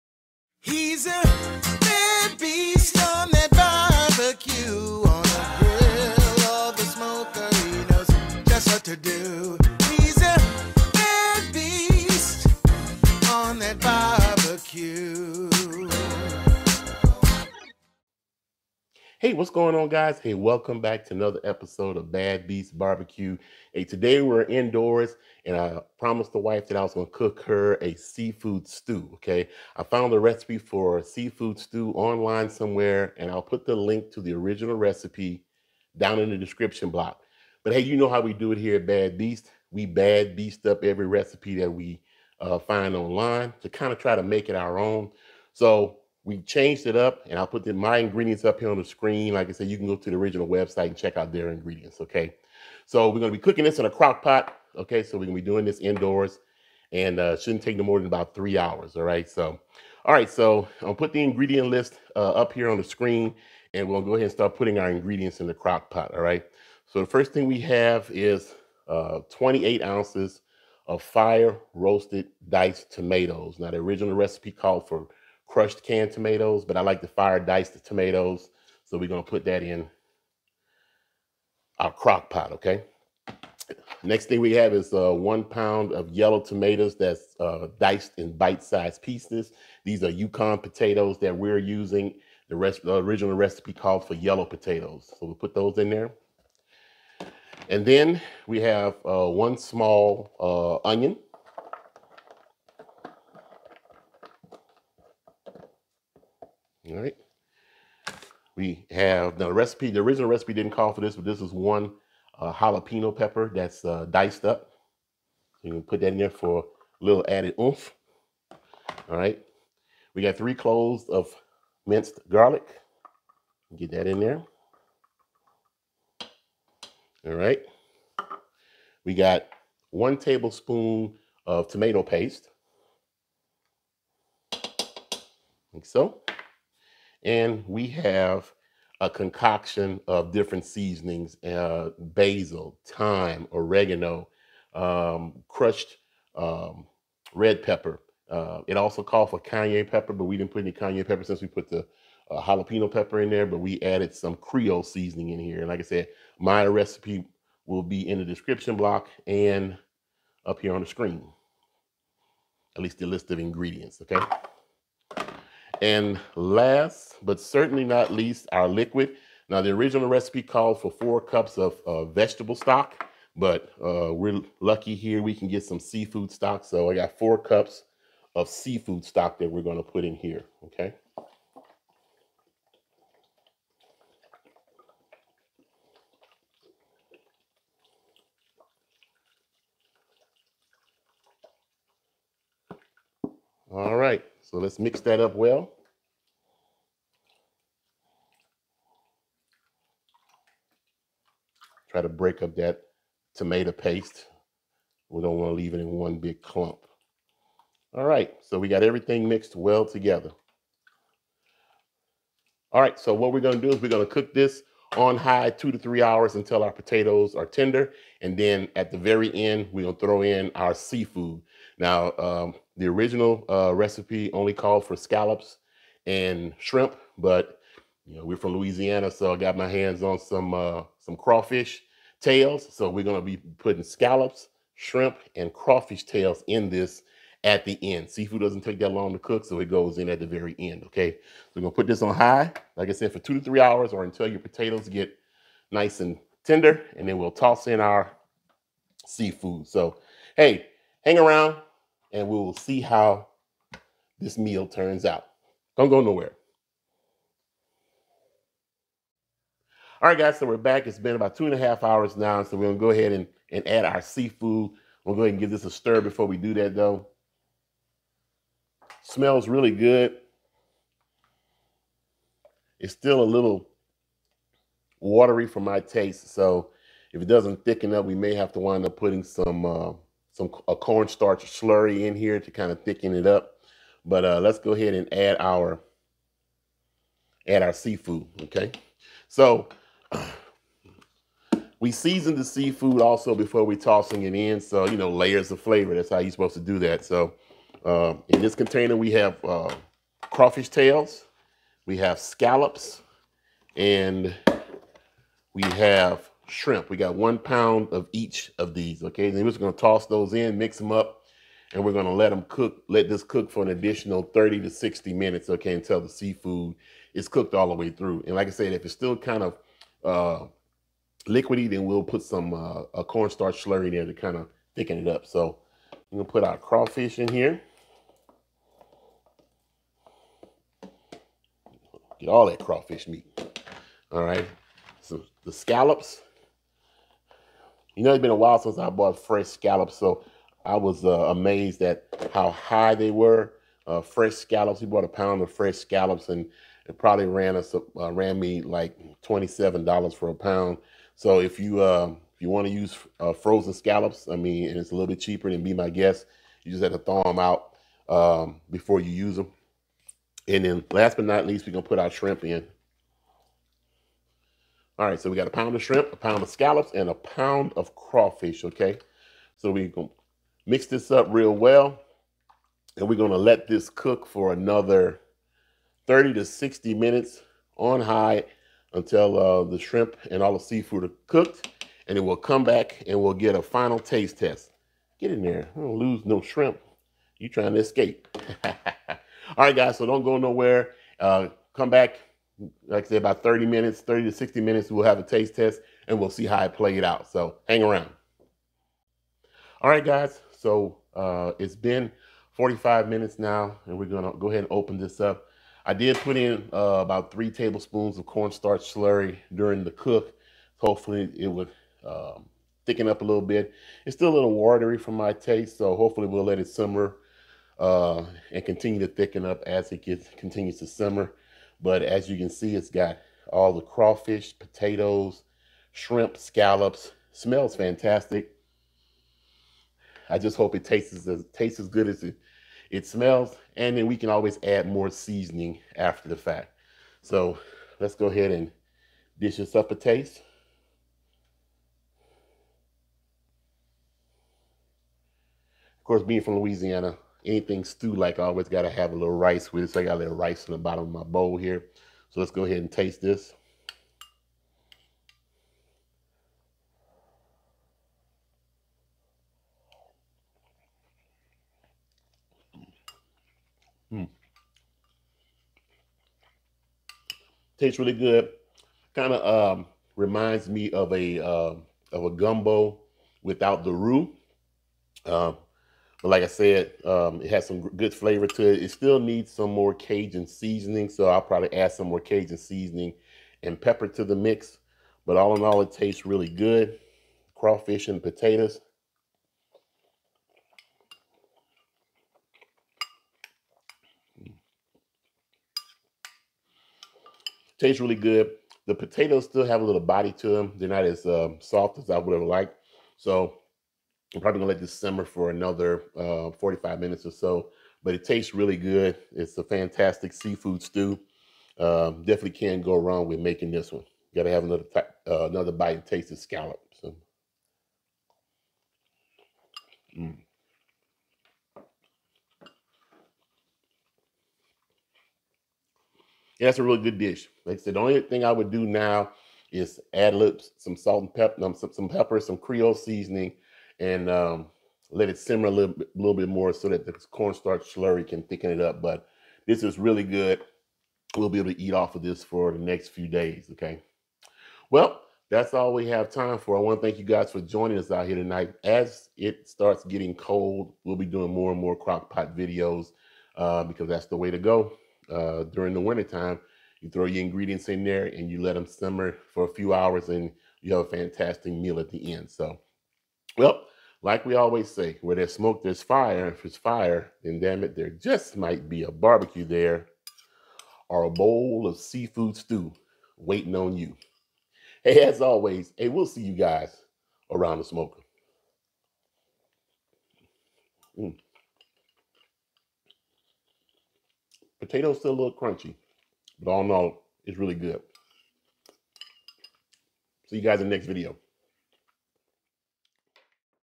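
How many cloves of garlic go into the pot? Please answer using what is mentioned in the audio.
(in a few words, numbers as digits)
3.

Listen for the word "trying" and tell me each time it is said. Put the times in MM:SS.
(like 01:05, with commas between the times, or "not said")
06:27.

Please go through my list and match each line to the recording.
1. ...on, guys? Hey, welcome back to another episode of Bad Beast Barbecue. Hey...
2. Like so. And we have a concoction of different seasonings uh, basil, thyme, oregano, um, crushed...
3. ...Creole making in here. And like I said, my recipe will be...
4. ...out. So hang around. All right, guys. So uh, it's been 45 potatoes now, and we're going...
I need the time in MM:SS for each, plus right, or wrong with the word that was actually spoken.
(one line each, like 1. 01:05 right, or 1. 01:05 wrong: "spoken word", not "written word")
1. 00:19 right
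2. 02:15 right
3. 02:34 wrong: "seasoning", not "making"
4. 06:37 wrong: "minutes", not "potatoes".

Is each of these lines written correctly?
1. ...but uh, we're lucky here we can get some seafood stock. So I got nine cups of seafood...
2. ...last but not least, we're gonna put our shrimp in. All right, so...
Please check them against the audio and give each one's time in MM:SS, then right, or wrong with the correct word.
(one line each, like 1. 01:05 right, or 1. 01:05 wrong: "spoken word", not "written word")
1. 02:53 wrong: "four", not "nine"
2. 06:00 right.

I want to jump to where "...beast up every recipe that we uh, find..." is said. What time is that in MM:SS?
00:40.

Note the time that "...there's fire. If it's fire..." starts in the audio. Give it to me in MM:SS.
09:25.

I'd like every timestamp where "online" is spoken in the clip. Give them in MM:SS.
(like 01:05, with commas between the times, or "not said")
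00:31, 00:42.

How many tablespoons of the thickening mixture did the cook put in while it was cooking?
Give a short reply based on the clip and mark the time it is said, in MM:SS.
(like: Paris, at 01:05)
3, at 06:47.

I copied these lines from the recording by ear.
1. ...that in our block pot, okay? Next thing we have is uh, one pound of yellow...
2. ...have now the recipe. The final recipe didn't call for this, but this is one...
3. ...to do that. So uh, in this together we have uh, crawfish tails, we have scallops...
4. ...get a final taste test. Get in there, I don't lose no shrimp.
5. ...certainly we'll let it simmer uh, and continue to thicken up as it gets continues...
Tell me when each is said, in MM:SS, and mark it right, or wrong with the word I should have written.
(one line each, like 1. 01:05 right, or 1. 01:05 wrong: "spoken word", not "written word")
1. 01:19 wrong: "crock", not "block"
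2. 01:48 wrong: "original", not "final"
3. 04:56 wrong: "container", not "together"
4. 06:23 right
5. 06:55 wrong: "hopefully", not "certainly".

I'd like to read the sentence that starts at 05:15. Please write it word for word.
Okay, until the seafood is cooked all the way through.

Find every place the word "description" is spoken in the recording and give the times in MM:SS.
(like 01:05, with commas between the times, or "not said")
00:36, 02:38.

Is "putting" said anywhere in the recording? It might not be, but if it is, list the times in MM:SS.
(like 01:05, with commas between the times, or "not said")
01:04, 03:53, 04:38.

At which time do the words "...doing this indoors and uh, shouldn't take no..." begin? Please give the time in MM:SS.
00:55.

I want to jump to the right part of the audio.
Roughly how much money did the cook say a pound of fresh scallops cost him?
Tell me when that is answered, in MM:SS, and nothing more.
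05:49.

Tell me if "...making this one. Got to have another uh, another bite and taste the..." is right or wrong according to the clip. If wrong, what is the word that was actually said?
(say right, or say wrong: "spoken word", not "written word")
right.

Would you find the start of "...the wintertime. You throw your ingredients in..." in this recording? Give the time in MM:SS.
09:15.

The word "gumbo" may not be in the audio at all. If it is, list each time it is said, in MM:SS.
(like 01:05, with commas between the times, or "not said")
07:52.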